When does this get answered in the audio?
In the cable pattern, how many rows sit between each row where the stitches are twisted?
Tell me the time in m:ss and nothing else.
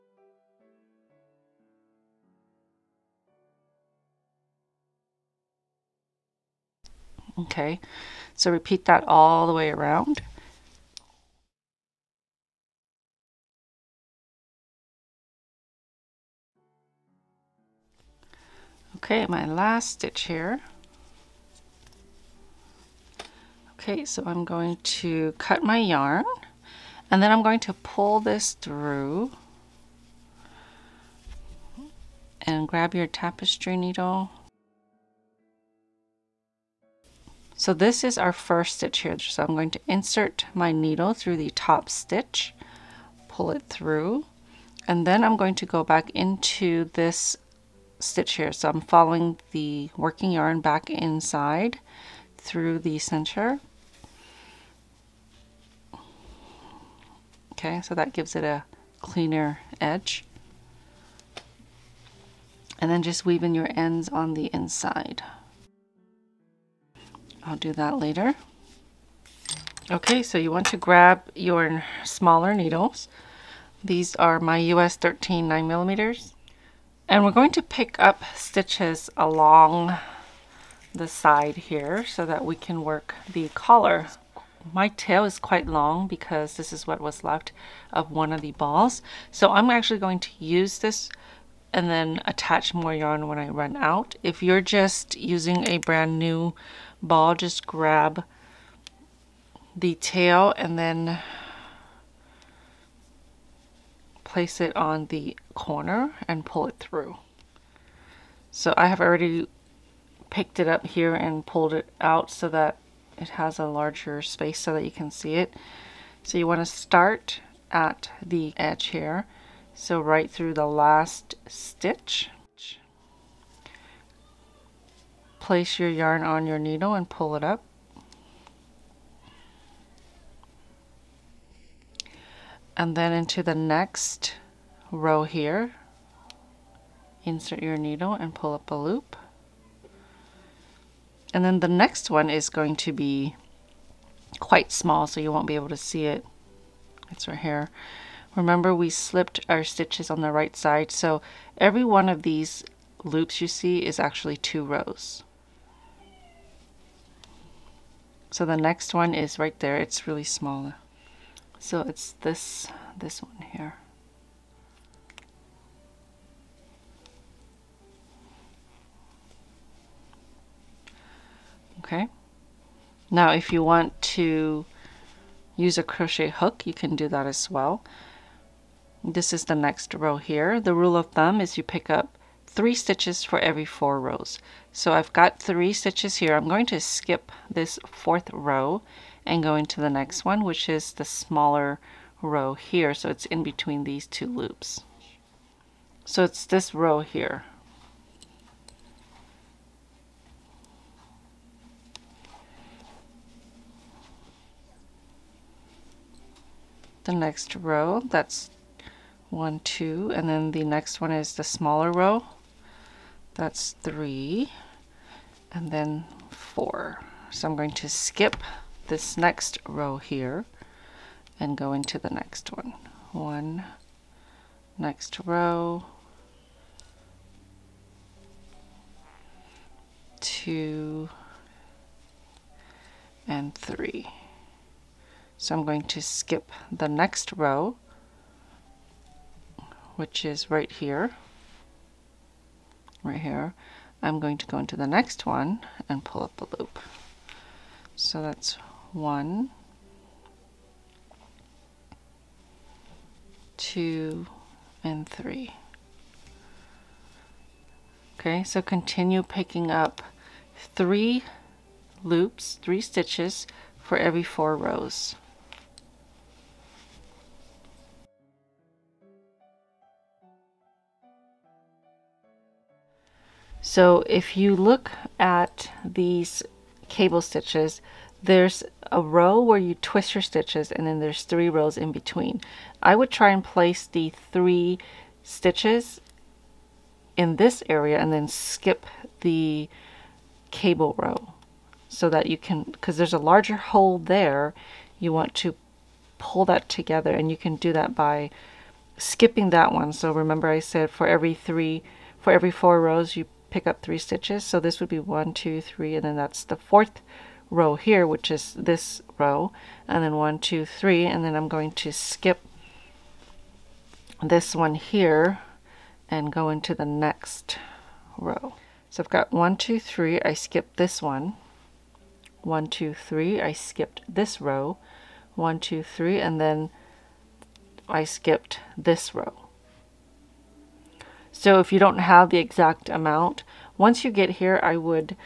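4:41.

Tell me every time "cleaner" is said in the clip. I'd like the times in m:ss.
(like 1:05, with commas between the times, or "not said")
0:58.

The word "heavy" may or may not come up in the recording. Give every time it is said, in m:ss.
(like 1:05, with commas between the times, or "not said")
not said.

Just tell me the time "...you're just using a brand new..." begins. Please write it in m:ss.
1:34.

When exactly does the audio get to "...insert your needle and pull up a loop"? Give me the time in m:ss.
2:17.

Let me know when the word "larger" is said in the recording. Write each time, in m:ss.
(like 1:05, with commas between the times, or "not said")
1:53, 4:53.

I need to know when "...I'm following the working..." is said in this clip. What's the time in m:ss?
0:48.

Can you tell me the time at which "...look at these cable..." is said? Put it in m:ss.
4:34.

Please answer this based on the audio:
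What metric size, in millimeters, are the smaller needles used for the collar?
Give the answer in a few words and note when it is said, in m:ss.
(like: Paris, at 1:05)
9 millimeters, at 1:15.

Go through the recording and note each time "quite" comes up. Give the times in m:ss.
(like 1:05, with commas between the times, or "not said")
1:25, 2:24.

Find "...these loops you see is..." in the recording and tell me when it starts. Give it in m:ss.
2:32.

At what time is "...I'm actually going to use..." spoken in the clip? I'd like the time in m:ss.
1:29.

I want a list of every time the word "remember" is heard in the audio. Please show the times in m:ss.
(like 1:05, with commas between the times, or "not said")
2:28, 5:00.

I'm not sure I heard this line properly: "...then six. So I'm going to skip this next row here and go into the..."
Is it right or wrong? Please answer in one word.
wrong.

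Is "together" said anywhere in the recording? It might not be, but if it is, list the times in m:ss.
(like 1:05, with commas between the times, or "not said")
4:56.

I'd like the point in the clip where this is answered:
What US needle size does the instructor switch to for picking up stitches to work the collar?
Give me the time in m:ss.
1:14.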